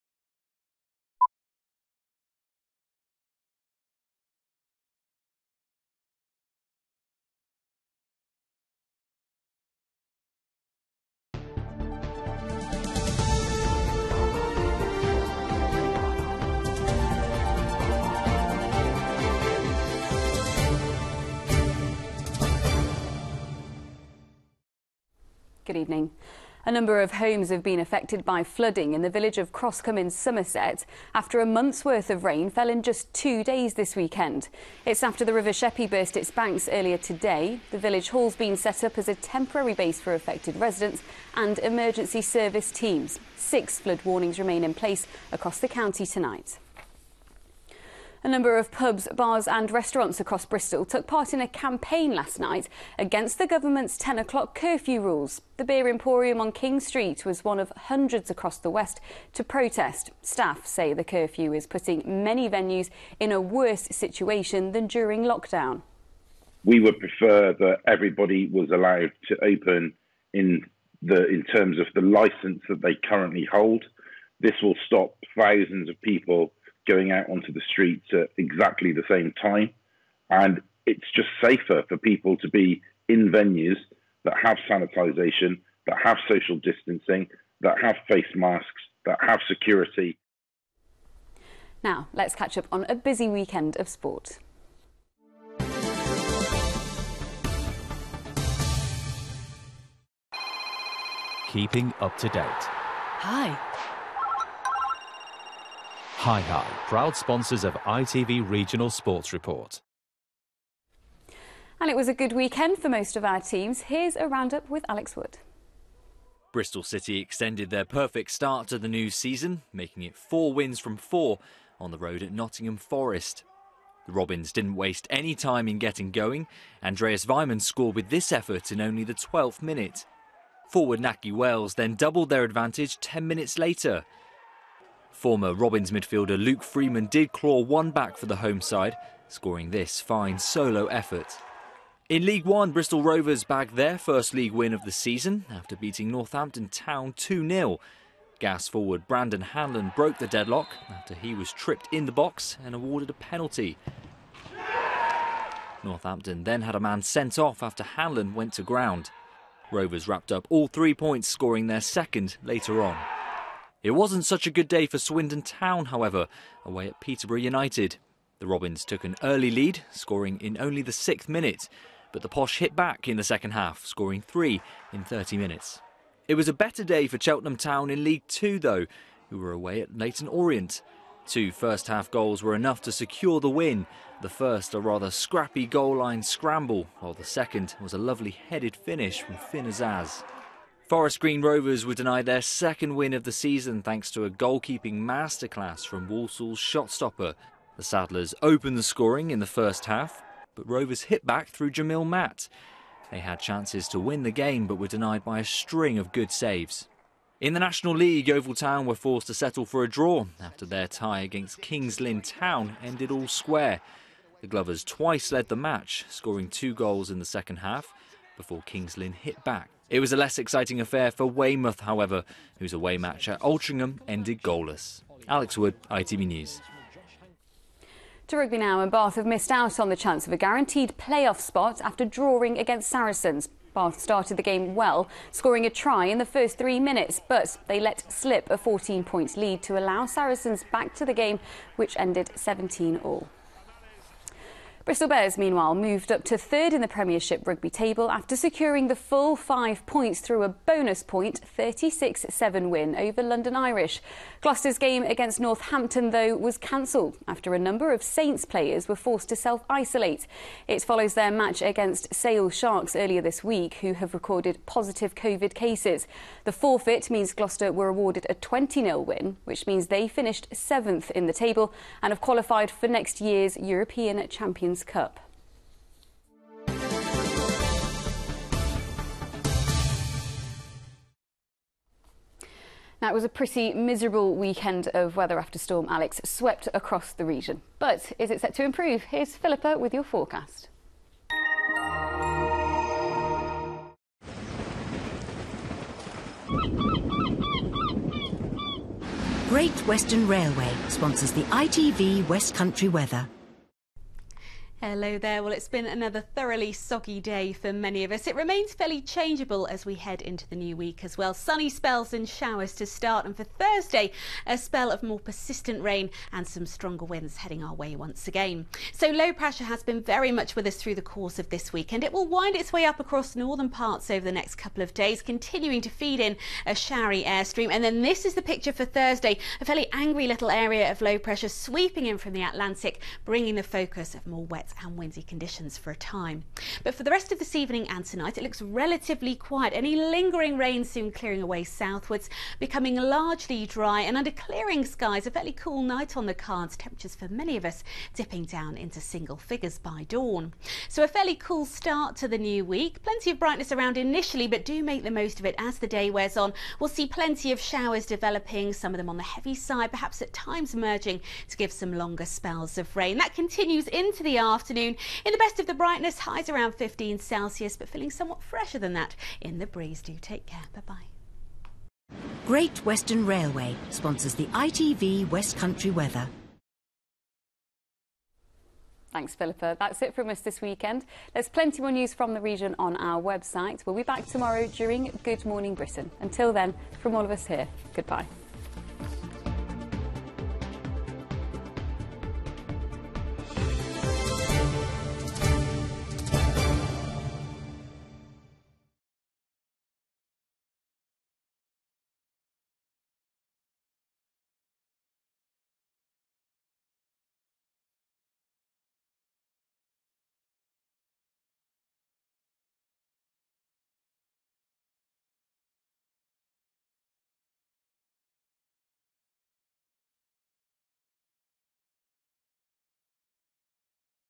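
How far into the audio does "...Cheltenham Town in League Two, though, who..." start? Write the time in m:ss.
2:57.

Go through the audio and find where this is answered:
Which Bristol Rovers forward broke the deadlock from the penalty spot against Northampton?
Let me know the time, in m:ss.
2:29.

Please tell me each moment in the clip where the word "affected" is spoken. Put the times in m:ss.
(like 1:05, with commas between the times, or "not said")
0:27, 0:40.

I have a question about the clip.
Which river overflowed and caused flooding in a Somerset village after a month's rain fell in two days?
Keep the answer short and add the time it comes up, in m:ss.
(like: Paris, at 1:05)
River Sheppey, at 0:35.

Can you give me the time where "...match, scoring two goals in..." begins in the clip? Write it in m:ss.
3:35.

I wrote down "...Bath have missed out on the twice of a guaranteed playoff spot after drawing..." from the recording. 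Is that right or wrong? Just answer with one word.
wrong.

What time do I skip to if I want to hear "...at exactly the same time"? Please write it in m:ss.
1:18.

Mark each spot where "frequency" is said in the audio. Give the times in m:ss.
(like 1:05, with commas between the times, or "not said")
not said.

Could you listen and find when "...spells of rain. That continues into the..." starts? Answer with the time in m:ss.
6:02.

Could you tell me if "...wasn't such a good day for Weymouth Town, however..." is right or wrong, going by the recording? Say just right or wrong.
wrong.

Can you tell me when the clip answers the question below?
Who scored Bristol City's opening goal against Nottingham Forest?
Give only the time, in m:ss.
2:06.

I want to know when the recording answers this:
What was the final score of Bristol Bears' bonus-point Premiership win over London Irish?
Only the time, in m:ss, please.
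4:11.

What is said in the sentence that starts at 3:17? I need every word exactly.
The Saddlers opened the scoring in the first half, but Rovers hit back through Jamille Matt.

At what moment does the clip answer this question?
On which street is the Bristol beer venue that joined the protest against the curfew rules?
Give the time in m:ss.
0:56.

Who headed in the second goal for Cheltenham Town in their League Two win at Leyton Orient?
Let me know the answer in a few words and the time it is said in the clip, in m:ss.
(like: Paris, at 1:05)
Finn Azaz, at 3:09.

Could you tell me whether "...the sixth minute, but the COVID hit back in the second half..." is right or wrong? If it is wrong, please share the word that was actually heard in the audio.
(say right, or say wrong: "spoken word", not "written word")
wrong: "Posh", not "COVID".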